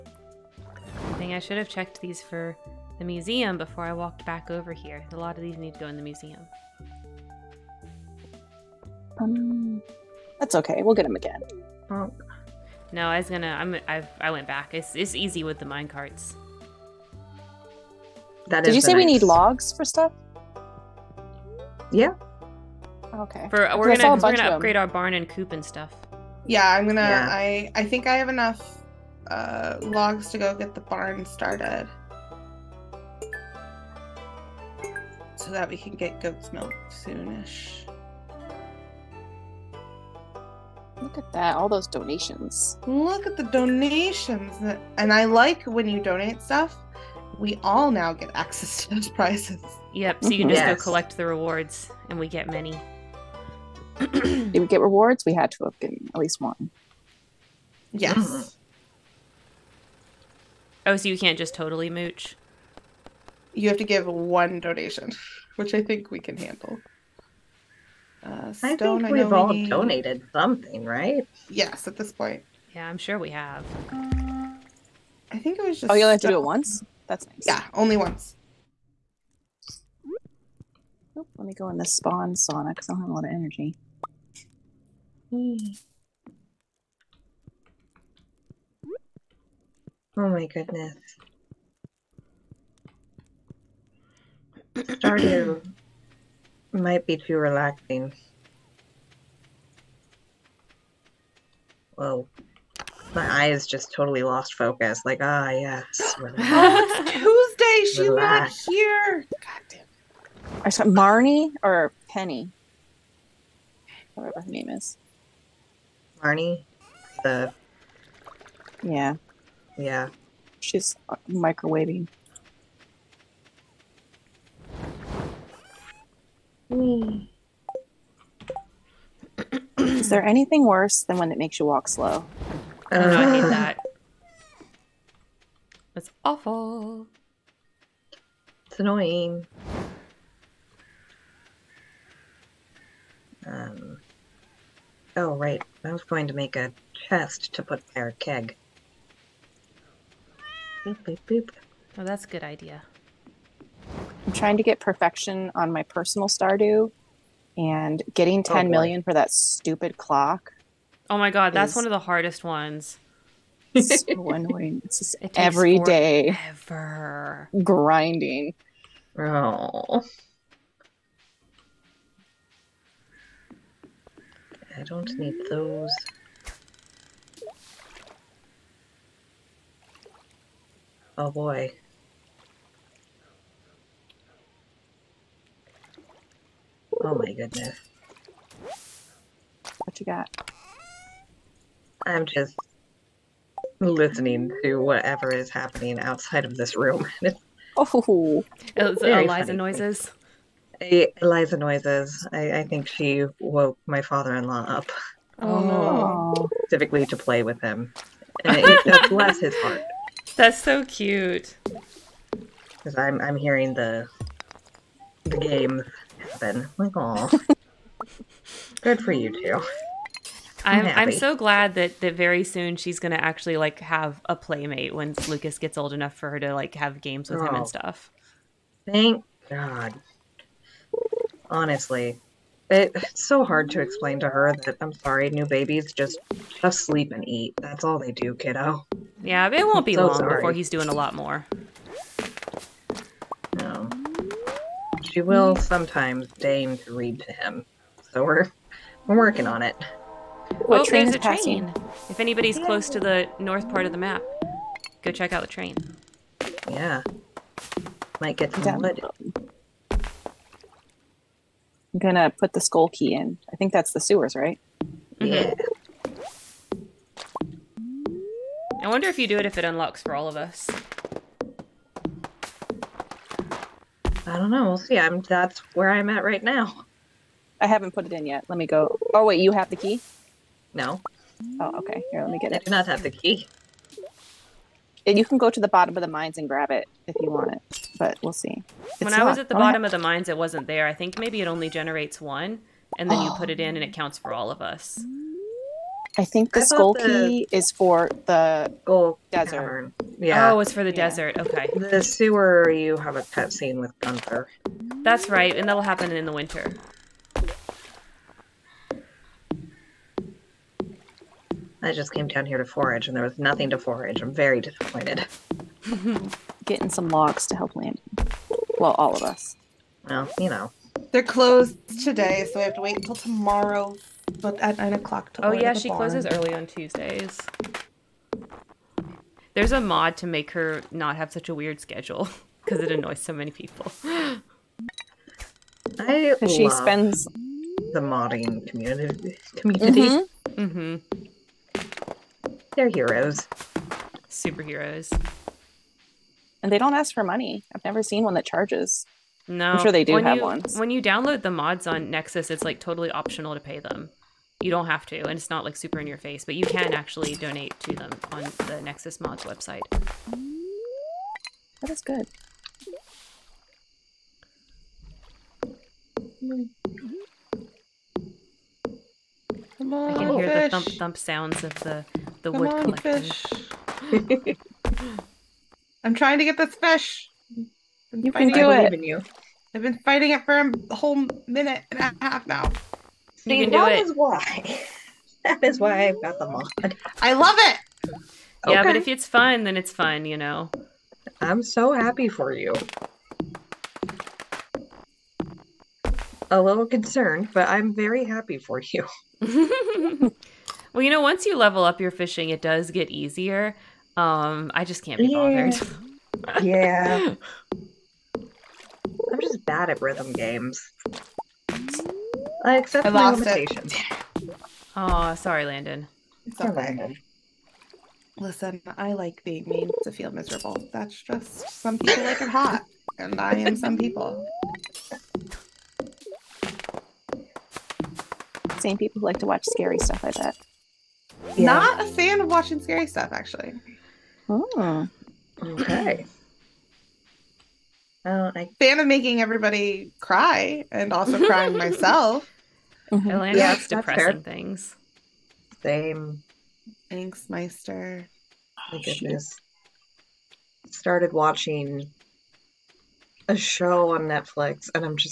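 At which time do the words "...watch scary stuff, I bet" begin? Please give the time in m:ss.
7:09.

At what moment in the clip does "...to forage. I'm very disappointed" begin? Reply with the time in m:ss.
5:13.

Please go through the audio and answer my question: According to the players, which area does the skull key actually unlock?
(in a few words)
Desert cavern.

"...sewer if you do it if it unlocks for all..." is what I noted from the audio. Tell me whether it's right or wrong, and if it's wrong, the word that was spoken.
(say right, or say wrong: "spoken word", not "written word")
wrong: "wonder", not "sewer".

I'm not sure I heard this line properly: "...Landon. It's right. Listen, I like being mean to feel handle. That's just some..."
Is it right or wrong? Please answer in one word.
wrong.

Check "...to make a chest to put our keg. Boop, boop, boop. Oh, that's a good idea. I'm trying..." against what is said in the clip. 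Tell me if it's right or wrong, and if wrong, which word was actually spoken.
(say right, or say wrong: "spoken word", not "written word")
right.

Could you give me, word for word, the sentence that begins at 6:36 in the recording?
A little concerned, but I'm very happy for you.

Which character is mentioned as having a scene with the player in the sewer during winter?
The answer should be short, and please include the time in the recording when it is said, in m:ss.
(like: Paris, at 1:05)
Gunther, at 5:03.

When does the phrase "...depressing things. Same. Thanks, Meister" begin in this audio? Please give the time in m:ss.
7:23.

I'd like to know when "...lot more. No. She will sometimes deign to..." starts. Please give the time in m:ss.
4:00.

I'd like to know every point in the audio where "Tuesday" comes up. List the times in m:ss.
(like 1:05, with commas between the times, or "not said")
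1:47, 5:26.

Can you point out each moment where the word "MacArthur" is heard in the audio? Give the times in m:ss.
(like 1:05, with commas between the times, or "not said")
not said.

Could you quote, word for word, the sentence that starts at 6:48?
I'm just bad at rhythm games.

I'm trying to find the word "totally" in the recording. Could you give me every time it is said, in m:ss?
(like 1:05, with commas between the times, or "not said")
1:01, 1:43, 5:52.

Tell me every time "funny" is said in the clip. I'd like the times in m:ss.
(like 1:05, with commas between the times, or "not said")
3:19.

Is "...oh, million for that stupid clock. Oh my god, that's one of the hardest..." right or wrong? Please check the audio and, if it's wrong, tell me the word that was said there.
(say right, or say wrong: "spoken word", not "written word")
right.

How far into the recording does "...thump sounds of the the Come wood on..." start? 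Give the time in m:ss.
6:10.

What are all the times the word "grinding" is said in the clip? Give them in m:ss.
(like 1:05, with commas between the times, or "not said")
2:47.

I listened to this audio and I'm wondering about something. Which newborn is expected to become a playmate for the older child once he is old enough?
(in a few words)
Lucas.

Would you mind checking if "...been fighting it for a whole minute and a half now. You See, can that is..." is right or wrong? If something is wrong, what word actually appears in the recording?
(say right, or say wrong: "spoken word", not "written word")
right.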